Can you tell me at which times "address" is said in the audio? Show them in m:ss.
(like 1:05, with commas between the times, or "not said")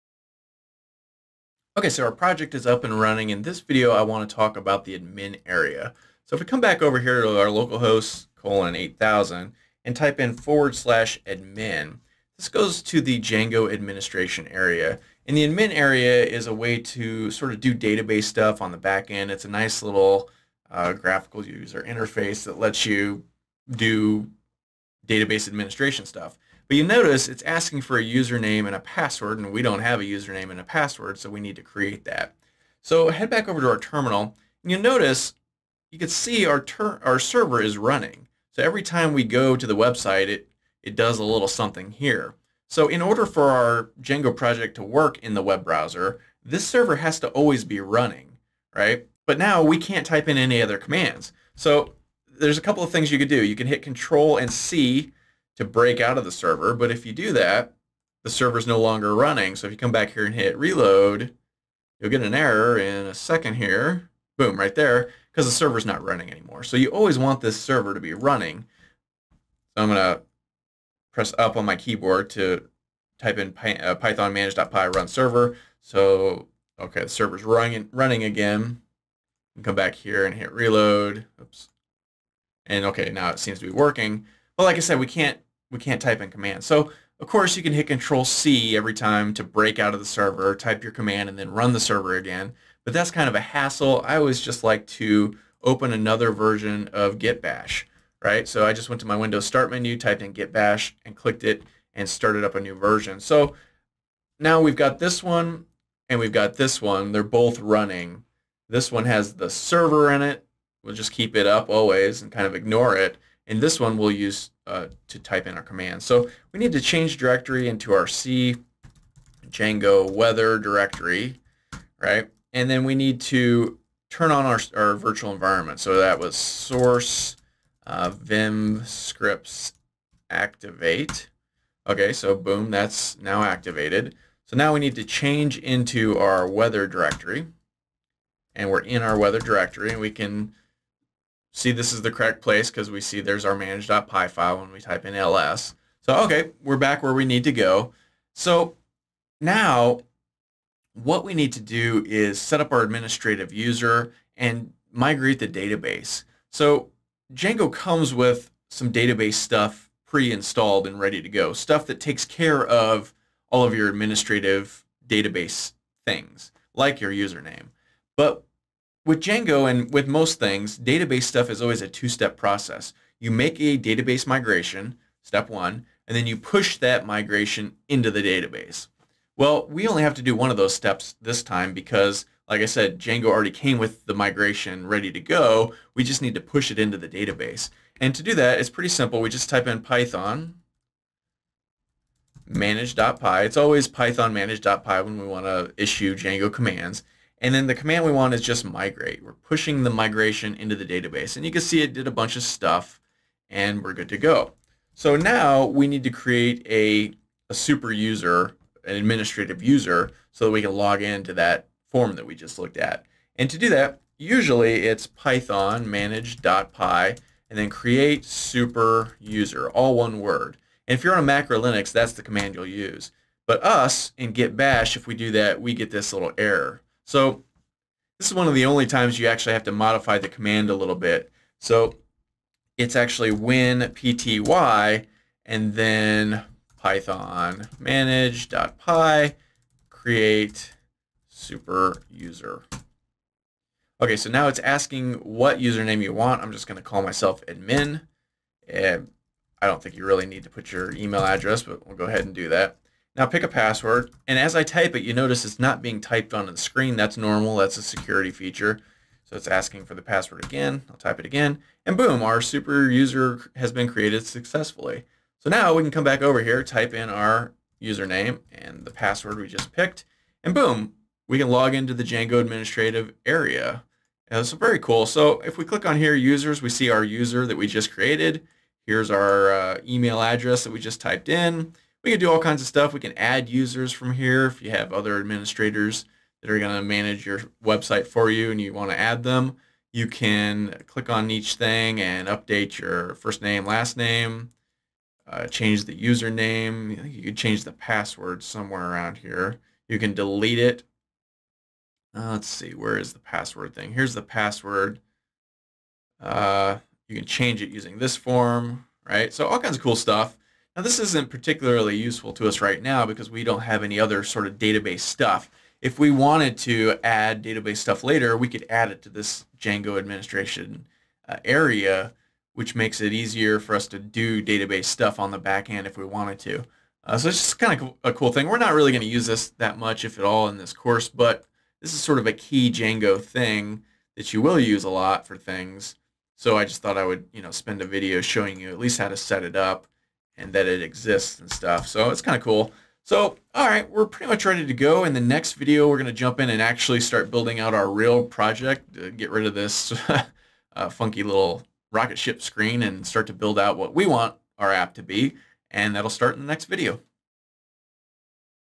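4:11, 4:40.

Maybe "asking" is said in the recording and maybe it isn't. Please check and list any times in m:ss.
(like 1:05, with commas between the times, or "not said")
0:27, 4:04, 4:19.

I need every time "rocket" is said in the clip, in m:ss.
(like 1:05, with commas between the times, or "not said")
5:51.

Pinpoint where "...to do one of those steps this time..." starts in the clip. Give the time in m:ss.
3:00.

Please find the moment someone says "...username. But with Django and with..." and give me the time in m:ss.
2:47.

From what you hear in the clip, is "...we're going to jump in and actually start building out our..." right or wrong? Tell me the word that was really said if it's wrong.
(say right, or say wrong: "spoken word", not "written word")
right.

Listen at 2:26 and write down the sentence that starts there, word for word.
So, okay, we're back where we need to go.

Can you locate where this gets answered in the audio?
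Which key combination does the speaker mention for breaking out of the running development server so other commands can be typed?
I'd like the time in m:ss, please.
0:53.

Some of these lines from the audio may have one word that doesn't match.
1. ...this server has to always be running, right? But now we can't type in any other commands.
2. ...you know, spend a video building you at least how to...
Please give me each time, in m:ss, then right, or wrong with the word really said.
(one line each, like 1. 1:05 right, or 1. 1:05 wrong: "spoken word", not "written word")
1. 0:46 right
2. 5:37 wrong: "showing", not "building".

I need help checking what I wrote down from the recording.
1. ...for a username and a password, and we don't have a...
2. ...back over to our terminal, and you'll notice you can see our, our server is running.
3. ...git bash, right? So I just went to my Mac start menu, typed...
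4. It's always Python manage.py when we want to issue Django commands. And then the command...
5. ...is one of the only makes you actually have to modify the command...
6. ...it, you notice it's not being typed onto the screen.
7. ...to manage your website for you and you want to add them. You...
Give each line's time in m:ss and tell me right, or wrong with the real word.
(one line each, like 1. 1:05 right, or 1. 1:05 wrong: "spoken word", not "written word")
1. 0:27 right
2. 0:33 right
3. 1:37 wrong: "Windows", not "Mac"
4. 3:13 right
5. 3:48 wrong: "times", not "makes"
6. 4:14 right
7. 4:46 right.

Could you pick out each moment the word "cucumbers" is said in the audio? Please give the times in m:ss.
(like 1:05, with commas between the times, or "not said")
not said.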